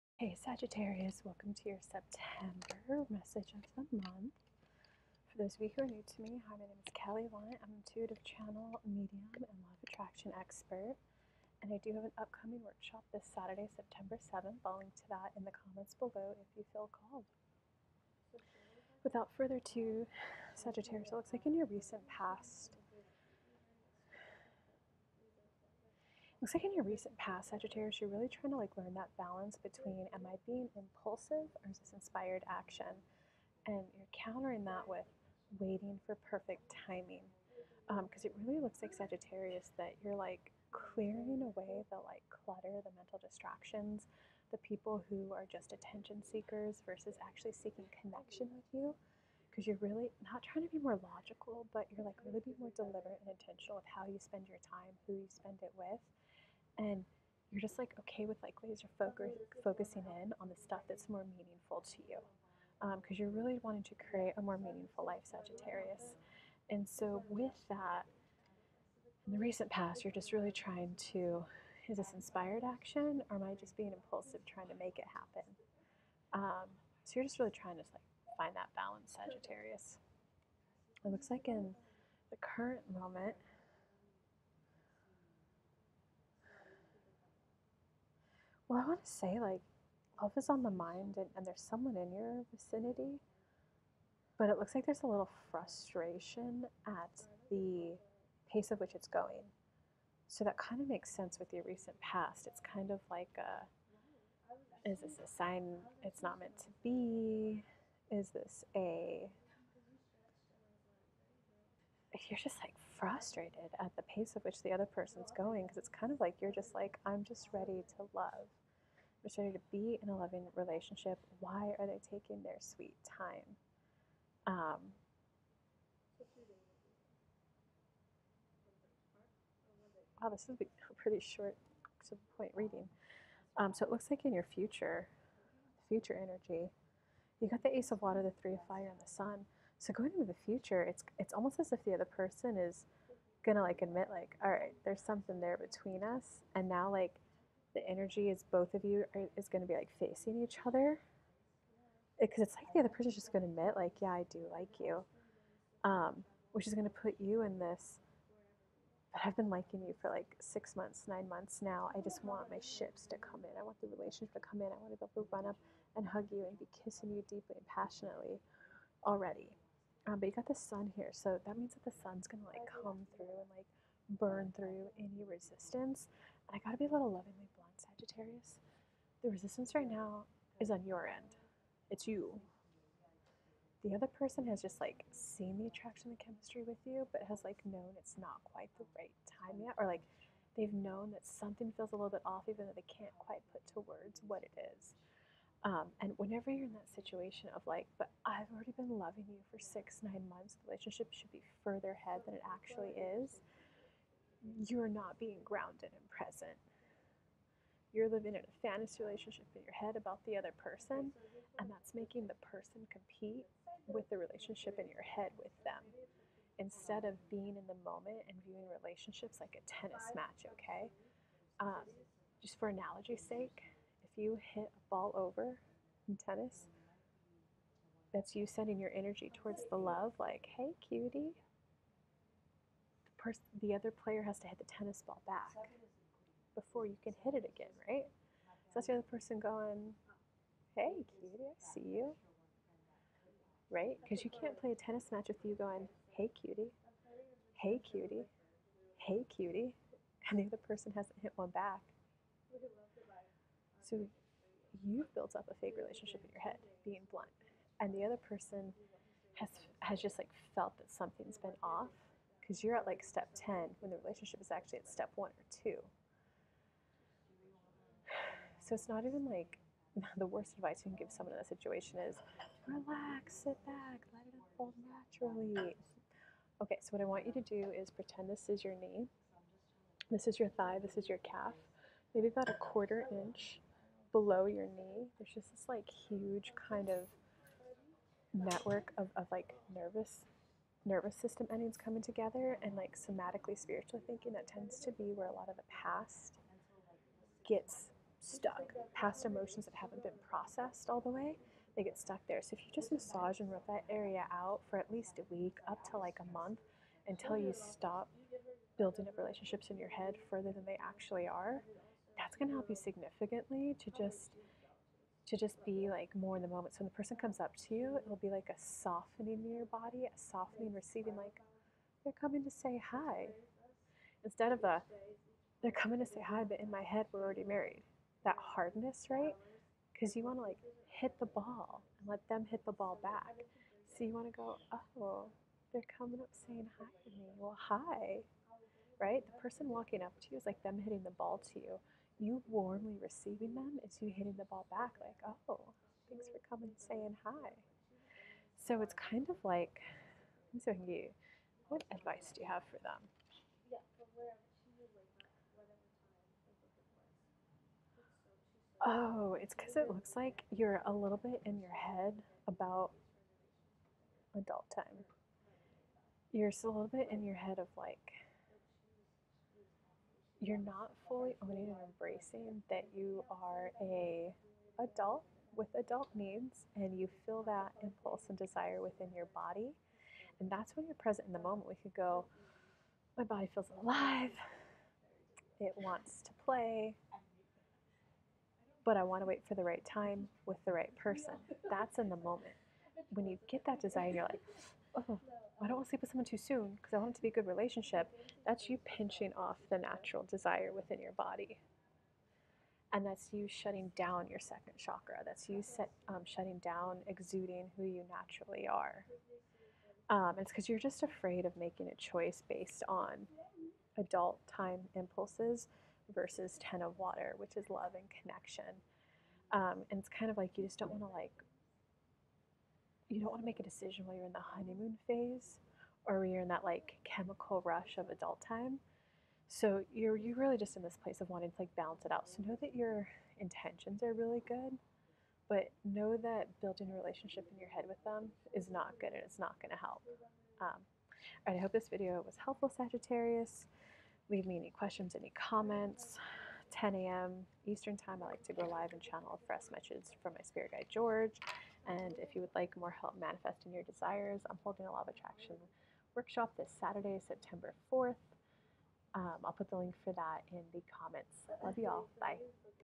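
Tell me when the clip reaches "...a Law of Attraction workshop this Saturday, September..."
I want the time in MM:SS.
07:34.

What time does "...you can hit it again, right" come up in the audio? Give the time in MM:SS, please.
03:56.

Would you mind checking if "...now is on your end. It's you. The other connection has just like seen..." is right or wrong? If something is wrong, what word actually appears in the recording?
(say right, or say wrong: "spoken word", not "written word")
wrong: "person", not "connection".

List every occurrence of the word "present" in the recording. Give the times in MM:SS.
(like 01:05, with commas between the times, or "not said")
03:26, 06:20.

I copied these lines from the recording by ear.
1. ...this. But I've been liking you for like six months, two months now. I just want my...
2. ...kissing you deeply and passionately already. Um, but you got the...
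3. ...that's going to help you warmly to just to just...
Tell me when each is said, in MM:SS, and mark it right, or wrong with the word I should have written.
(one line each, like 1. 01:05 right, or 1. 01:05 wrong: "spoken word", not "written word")
1. 02:37 wrong: "nine", not "two"
2. 02:46 right
3. 05:12 wrong: "significantly", not "warmly".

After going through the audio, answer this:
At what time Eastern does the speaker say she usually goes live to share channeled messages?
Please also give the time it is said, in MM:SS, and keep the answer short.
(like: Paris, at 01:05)
10 a.m., at 07:26.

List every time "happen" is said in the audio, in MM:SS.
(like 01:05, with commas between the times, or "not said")
01:15.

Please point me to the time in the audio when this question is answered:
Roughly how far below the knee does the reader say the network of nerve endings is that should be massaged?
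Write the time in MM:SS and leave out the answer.
04:42.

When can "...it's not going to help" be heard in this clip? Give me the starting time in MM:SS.
07:19.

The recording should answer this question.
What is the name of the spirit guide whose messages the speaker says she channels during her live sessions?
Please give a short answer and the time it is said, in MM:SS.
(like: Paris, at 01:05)
George, at 07:30.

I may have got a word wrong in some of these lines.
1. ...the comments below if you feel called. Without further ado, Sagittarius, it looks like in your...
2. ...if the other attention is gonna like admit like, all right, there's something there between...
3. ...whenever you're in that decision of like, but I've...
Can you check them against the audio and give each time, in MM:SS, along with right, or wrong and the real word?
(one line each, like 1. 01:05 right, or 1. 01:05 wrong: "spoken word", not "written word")
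1. 00:15 right
2. 02:21 wrong: "person", not "attention"
3. 03:16 wrong: "situation", not "decision".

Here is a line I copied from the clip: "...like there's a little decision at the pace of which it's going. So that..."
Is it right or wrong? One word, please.
wrong.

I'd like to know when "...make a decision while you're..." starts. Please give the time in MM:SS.
07:03.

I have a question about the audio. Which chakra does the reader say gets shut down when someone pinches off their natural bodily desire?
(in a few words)
Second chakra.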